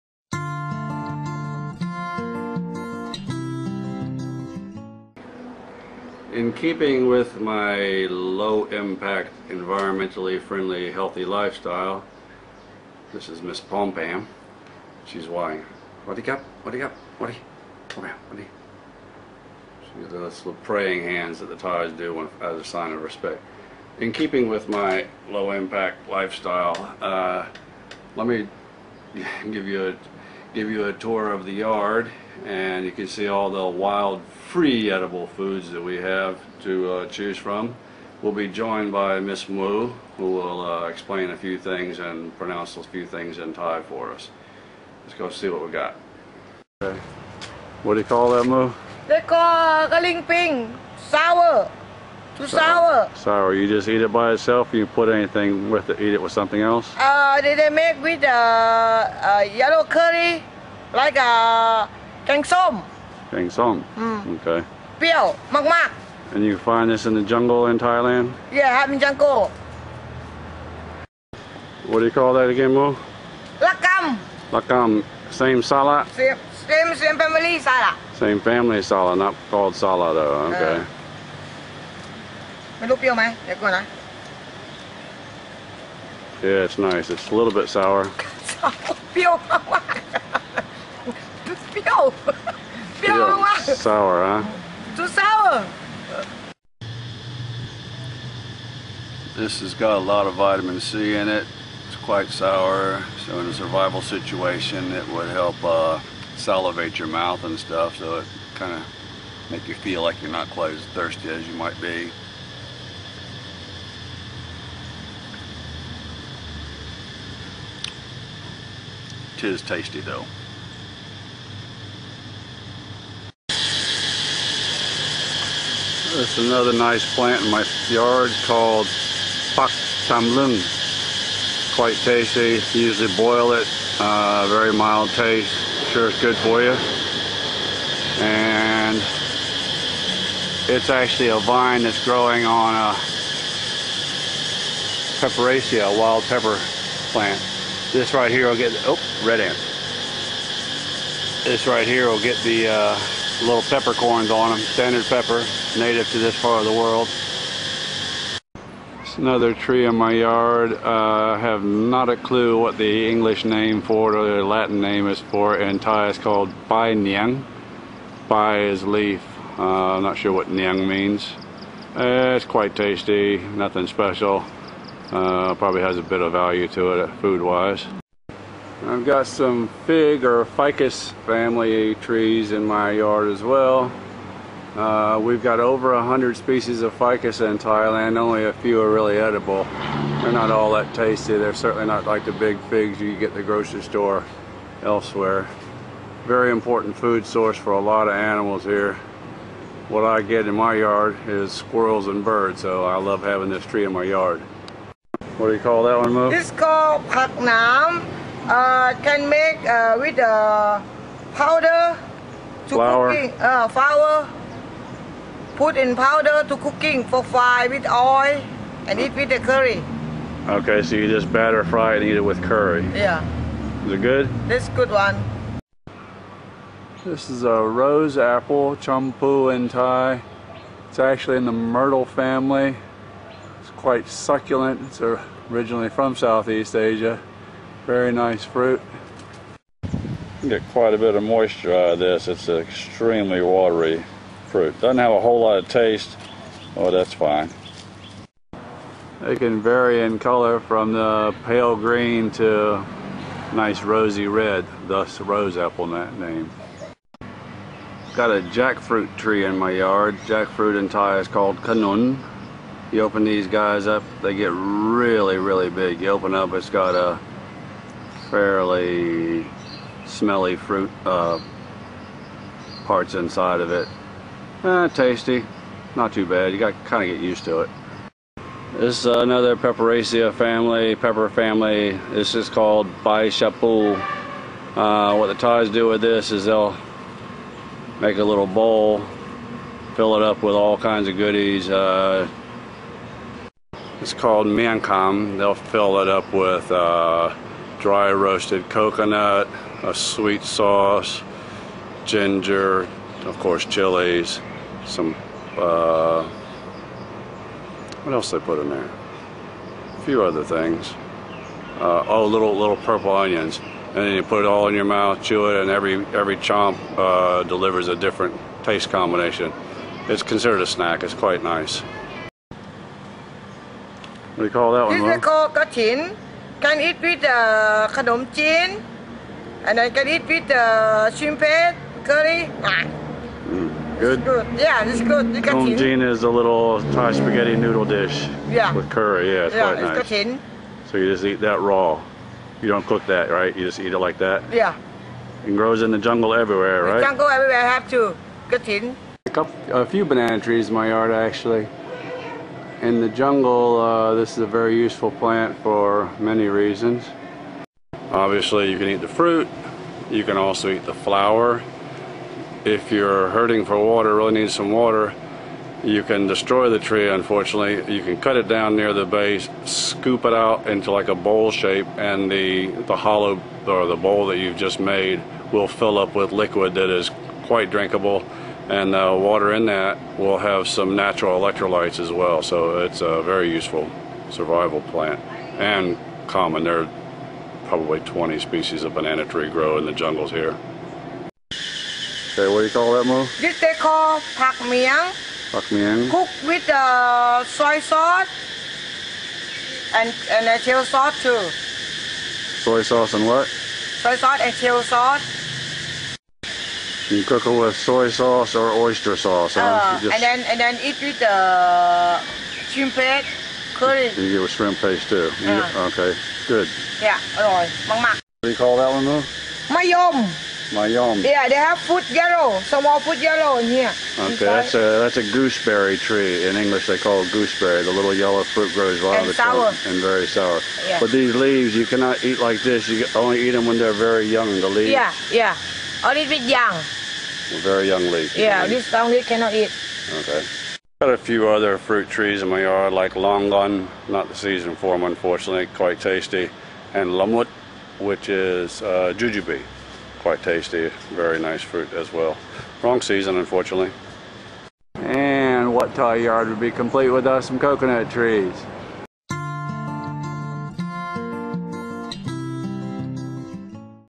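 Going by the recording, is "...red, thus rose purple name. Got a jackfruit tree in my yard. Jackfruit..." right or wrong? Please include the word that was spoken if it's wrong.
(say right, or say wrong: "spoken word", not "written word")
wrong: "apple", not "purple".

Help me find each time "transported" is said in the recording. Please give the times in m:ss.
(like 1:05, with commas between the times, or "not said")
not said.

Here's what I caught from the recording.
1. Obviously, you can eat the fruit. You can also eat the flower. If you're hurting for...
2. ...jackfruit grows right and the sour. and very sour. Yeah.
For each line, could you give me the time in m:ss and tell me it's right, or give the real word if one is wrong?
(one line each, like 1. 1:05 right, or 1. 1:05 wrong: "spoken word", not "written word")
1. 5:58 right
2. 7:08 wrong: "fruit", not "jackfruit".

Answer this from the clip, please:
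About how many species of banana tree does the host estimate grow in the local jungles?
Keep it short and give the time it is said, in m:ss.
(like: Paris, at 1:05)
20, at 6:27.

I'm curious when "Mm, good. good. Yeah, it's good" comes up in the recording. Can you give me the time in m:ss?
5:33.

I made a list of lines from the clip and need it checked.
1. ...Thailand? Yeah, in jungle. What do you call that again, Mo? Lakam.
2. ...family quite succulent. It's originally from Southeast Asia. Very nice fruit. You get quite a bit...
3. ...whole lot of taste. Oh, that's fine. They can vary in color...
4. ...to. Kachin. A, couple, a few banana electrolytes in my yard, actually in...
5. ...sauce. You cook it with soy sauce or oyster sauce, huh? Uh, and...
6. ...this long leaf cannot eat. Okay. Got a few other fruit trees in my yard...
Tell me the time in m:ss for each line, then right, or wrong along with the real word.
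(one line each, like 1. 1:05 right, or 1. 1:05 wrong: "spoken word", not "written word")
1. 1:07 right
2. 3:52 right
3. 4:05 right
4. 5:47 wrong: "trees", not "electrolytes"
5. 6:44 right
6. 7:18 right.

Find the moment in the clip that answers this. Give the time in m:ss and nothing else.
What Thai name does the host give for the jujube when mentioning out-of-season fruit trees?
7:27.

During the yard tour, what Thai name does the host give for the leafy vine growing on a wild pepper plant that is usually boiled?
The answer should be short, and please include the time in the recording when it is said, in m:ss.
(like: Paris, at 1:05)
pak tamlung, at 2:09.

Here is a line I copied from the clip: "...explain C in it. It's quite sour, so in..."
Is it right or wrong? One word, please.
wrong.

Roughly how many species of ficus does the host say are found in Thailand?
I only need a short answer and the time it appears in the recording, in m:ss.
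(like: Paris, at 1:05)
over 100, at 3:05.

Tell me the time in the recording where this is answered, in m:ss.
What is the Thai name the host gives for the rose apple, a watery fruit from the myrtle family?
3:48.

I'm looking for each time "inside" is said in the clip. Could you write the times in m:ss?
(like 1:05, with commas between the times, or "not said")
4:33, 7:04.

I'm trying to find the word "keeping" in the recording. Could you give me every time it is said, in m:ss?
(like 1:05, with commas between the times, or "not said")
0:06, 0:24.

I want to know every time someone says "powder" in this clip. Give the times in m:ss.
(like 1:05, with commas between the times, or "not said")
3:31, 3:35.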